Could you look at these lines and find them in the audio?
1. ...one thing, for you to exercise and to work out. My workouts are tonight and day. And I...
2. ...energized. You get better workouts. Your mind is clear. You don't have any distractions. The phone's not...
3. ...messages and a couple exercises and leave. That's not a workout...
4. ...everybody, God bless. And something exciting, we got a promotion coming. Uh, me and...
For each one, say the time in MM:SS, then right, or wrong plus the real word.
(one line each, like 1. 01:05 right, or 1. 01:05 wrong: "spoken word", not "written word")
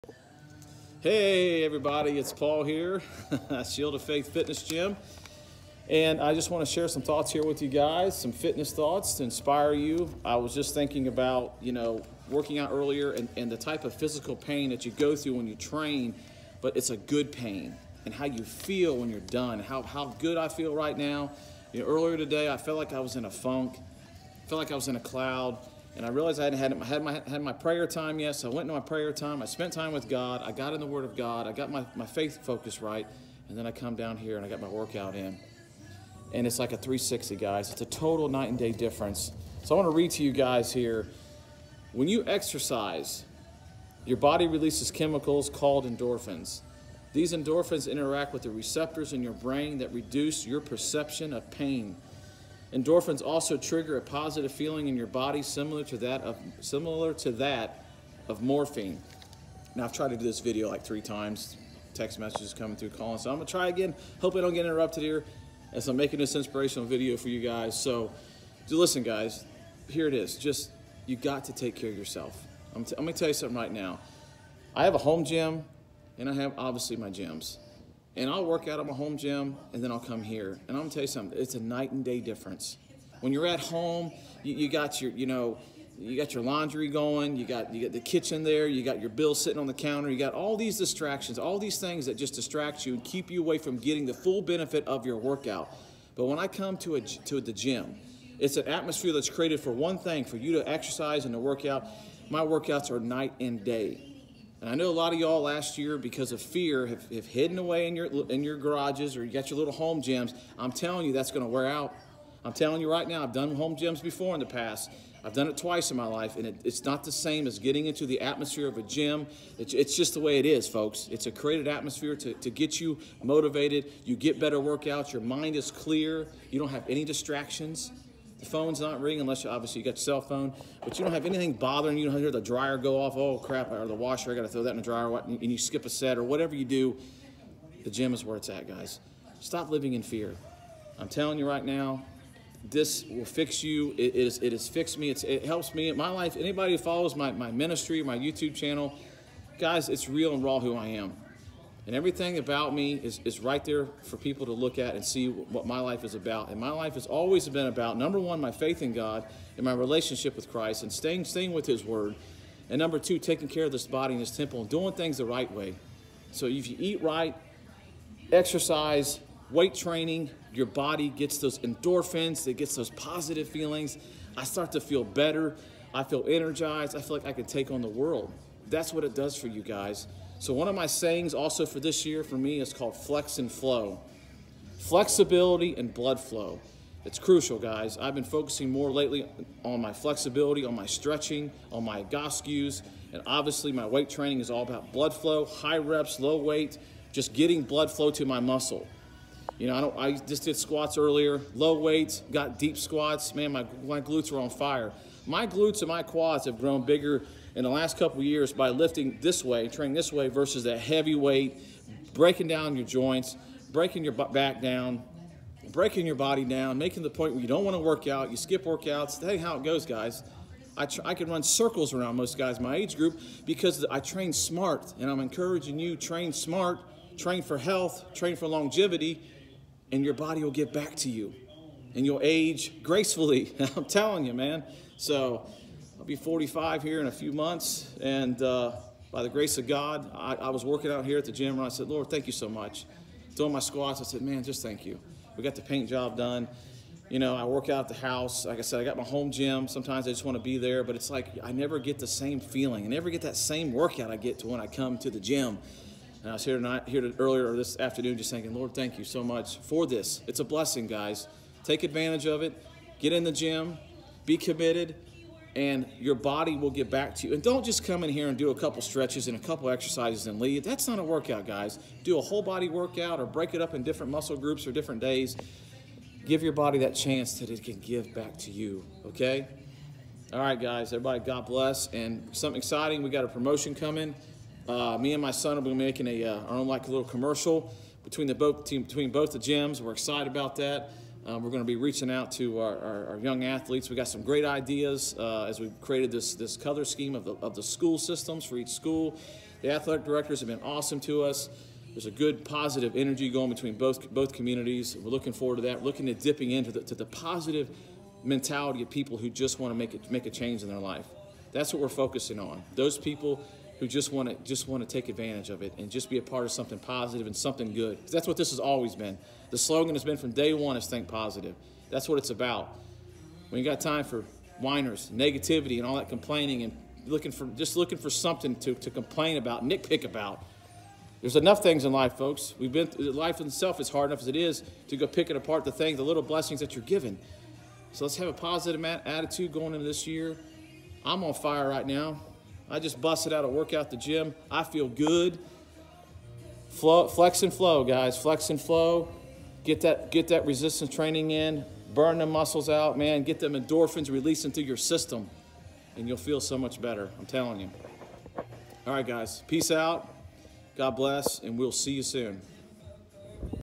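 1. 01:39 wrong: "night", not "tonight"
2. 02:03 wrong: "motivated", not "energized"
3. 04:28 wrong: "stretches", not "messages"
4. 04:40 right.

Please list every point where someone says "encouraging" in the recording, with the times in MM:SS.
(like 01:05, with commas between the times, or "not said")
03:45.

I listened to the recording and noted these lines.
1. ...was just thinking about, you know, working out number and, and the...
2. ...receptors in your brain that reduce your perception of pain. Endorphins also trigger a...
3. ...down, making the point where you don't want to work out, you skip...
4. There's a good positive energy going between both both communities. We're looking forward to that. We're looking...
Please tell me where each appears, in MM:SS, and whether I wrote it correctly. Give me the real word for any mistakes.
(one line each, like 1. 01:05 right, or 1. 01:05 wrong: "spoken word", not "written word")
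1. 00:10 wrong: "earlier", not "number"
2. 00:48 right
3. 03:36 right
4. 05:01 right.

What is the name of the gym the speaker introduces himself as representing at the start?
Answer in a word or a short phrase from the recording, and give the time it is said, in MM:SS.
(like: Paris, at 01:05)
Shield of Faith Fitness Gym, at 00:03.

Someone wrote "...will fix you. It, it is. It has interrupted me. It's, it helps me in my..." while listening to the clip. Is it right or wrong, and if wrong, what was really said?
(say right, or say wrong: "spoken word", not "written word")
wrong: "fixed", not "interrupted".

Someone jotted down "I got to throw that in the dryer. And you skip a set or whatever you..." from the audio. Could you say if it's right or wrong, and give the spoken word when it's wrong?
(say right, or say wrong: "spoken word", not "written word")
right.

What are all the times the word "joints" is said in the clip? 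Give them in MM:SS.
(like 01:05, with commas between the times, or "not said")
03:32.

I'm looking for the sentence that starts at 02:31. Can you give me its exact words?
And everything about me is, is right there for people to look at and see what my life is about.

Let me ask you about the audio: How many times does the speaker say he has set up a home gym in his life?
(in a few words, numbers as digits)
Twice.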